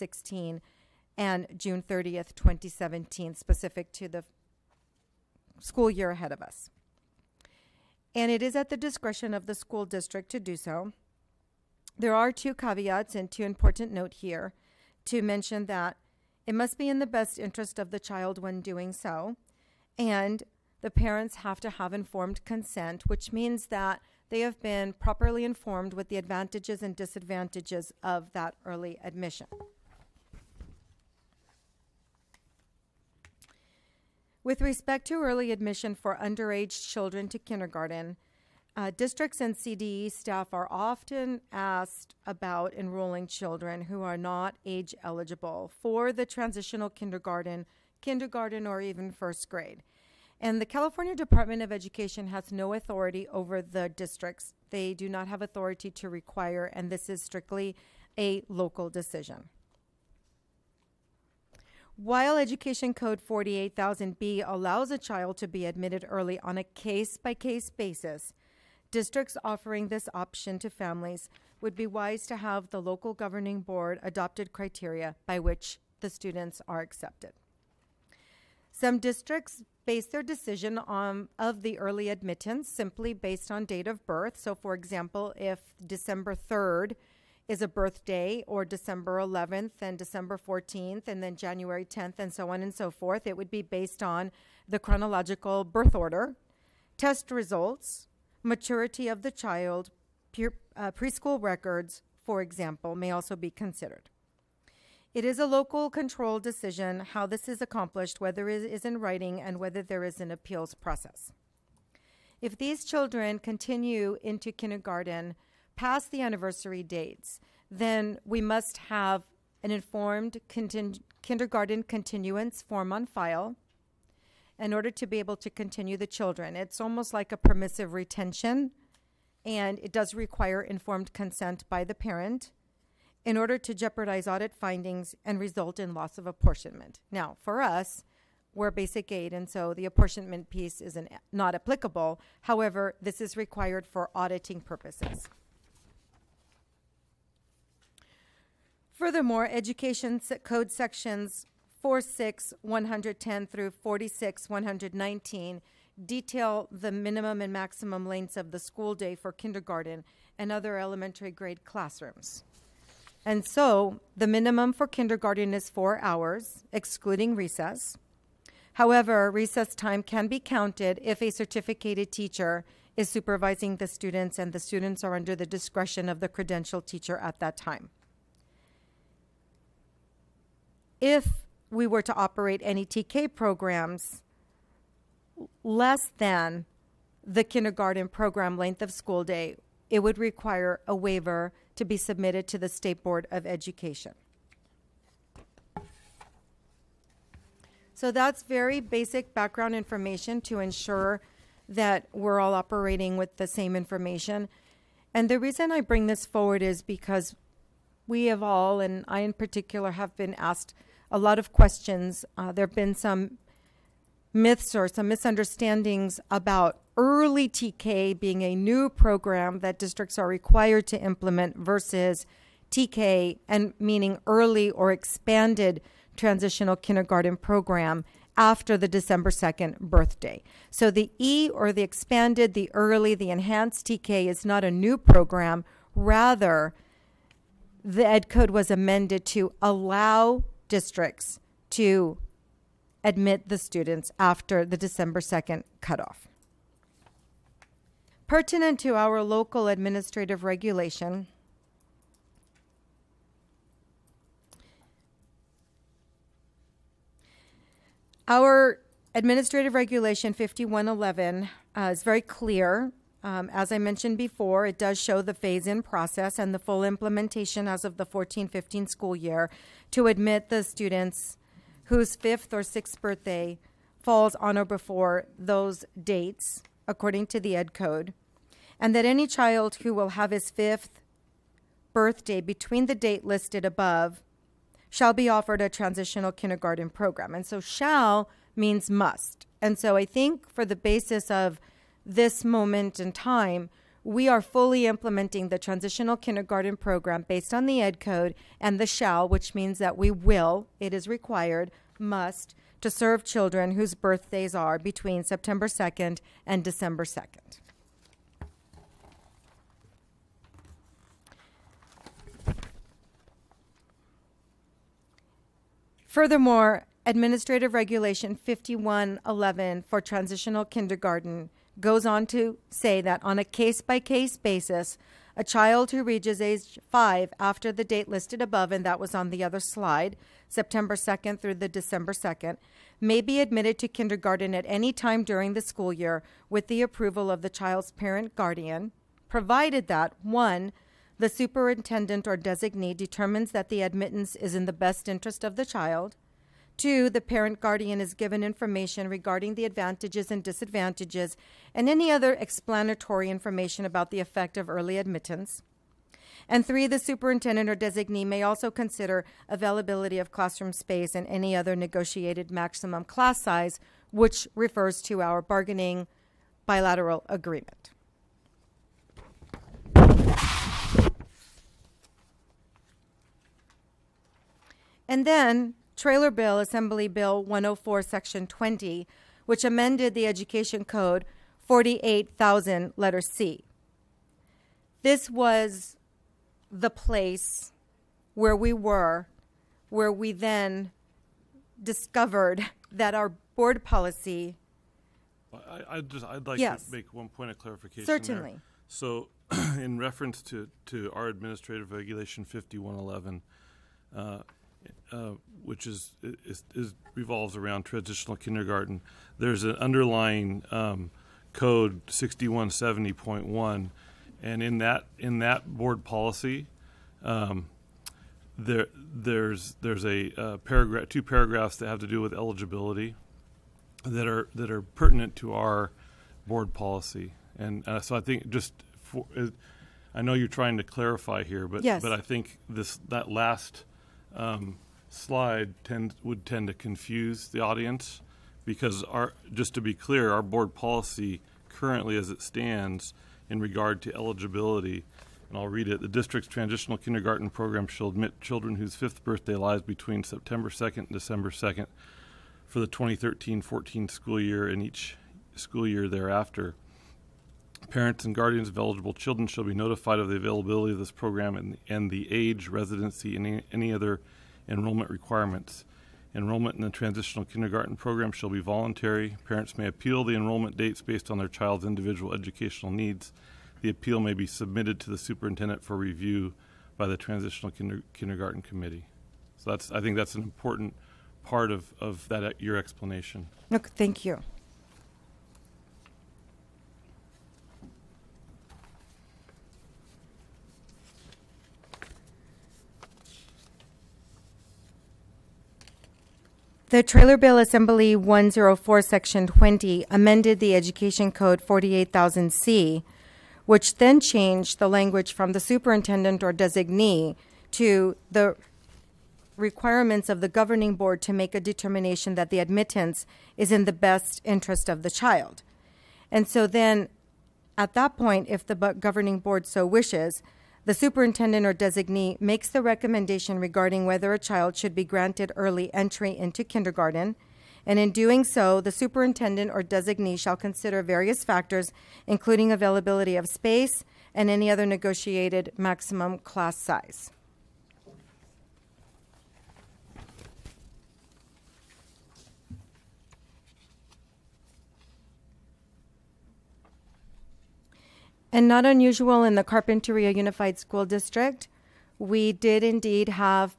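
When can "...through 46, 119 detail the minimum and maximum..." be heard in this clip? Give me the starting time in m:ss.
2:33.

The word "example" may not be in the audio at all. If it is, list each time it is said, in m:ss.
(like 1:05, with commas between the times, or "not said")
1:24, 1:42.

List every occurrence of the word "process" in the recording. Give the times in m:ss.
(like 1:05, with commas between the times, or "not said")
1:50, 4:25.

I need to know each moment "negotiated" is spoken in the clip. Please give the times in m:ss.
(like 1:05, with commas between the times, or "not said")
6:01, 8:54.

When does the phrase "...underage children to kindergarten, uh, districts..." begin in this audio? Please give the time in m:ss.
0:36.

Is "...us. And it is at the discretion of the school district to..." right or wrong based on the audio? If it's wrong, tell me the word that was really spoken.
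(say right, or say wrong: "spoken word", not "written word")
right.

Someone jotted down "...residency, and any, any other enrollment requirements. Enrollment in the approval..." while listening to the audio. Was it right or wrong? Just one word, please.
wrong.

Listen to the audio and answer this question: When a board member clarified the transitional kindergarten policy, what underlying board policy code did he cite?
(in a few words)
6170.1.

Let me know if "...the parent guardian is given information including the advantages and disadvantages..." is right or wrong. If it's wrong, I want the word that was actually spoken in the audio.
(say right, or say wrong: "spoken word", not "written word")
wrong: "regarding", not "including".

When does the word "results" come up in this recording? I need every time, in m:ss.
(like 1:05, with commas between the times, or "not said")
1:37, 2:15.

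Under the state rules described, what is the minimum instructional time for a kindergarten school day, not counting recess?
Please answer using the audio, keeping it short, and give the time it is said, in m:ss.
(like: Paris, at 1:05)
4 hours, at 2:45.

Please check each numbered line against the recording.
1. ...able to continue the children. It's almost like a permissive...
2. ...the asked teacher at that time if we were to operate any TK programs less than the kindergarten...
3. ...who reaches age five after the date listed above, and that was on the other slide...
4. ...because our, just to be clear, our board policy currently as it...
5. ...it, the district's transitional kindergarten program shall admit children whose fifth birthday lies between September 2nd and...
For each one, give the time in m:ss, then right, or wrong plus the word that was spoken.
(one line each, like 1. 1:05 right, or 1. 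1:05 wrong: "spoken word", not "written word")
1. 2:05 right
2. 2:56 wrong: "credentialed", not "asked"
3. 5:25 right
4. 7:18 right
5. 7:25 right.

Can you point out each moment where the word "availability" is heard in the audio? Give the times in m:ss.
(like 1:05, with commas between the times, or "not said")
5:59, 7:40, 8:52.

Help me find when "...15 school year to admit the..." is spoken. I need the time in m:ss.
4:28.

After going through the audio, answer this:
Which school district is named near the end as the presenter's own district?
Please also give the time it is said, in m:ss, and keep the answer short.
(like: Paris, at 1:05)
Carpinteria Unified School District, at 9:09.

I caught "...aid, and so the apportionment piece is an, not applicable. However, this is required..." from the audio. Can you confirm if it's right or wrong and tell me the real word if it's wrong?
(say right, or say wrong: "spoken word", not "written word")
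right.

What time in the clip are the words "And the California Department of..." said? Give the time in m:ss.
0:50.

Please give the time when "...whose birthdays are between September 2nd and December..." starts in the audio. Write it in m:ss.
5:03.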